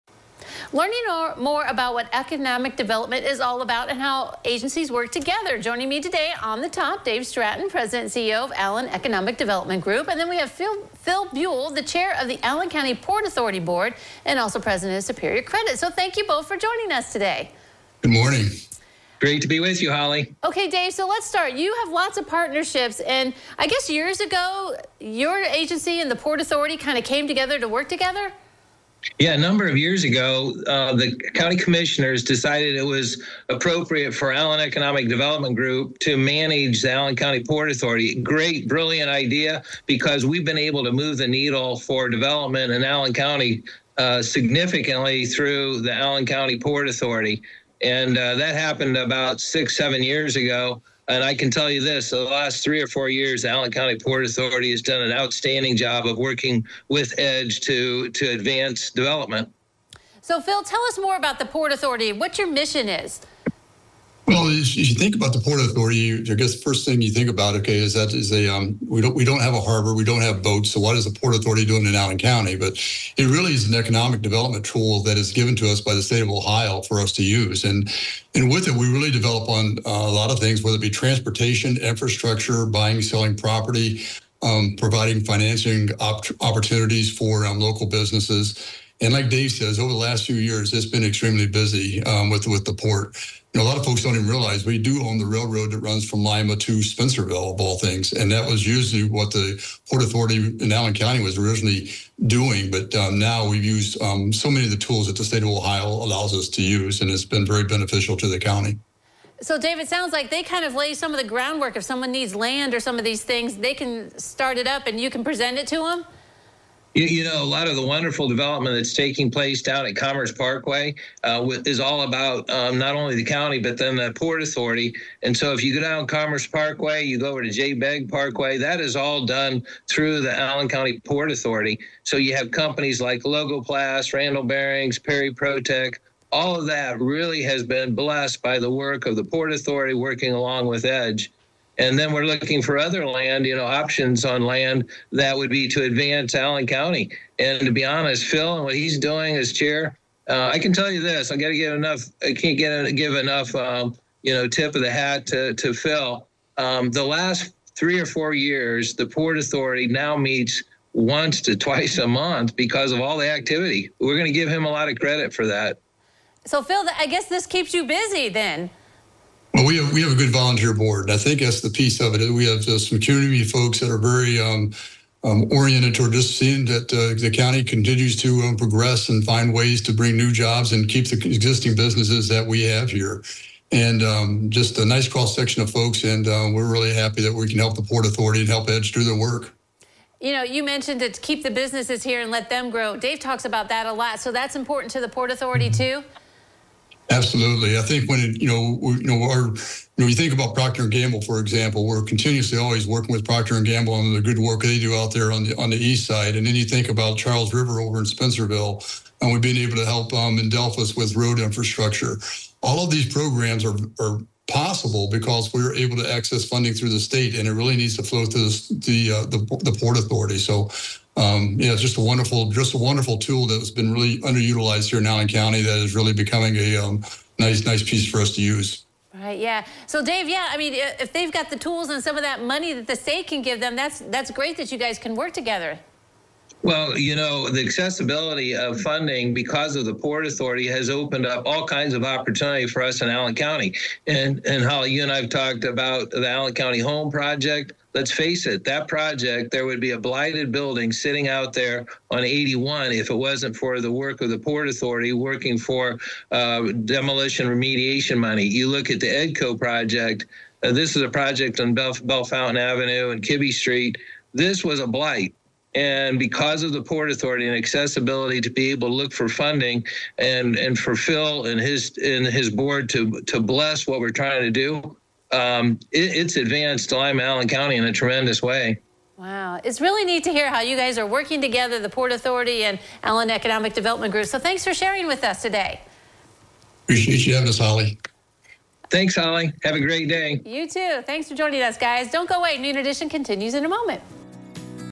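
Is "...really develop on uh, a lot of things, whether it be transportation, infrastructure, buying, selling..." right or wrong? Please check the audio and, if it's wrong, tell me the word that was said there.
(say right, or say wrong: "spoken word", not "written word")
right.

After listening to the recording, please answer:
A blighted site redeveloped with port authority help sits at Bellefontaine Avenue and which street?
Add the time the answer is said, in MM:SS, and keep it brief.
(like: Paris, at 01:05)
Kibby Street, at 04:23.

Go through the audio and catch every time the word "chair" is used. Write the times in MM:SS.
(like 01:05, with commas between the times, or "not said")
00:11, 02:29.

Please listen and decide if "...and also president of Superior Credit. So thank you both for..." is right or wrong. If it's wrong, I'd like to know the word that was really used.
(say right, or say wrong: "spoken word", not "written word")
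right.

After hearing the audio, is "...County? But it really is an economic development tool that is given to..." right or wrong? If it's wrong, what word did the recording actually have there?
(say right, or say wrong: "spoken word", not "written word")
right.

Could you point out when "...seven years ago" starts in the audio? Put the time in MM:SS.
00:49.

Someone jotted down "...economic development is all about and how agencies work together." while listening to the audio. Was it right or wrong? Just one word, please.
right.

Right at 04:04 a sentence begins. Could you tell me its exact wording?
And and Holly, you and I've talked about the Allen County Home Project.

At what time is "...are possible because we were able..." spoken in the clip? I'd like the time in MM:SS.
03:33.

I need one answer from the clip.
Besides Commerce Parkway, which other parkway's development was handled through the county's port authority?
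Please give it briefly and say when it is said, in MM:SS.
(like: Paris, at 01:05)
J. Begg Parkway, at 02:07.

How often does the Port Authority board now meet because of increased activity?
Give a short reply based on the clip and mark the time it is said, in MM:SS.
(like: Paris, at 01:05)
Once to twice a month, at 02:40.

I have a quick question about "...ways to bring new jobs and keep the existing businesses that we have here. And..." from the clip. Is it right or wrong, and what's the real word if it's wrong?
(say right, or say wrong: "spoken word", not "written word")
right.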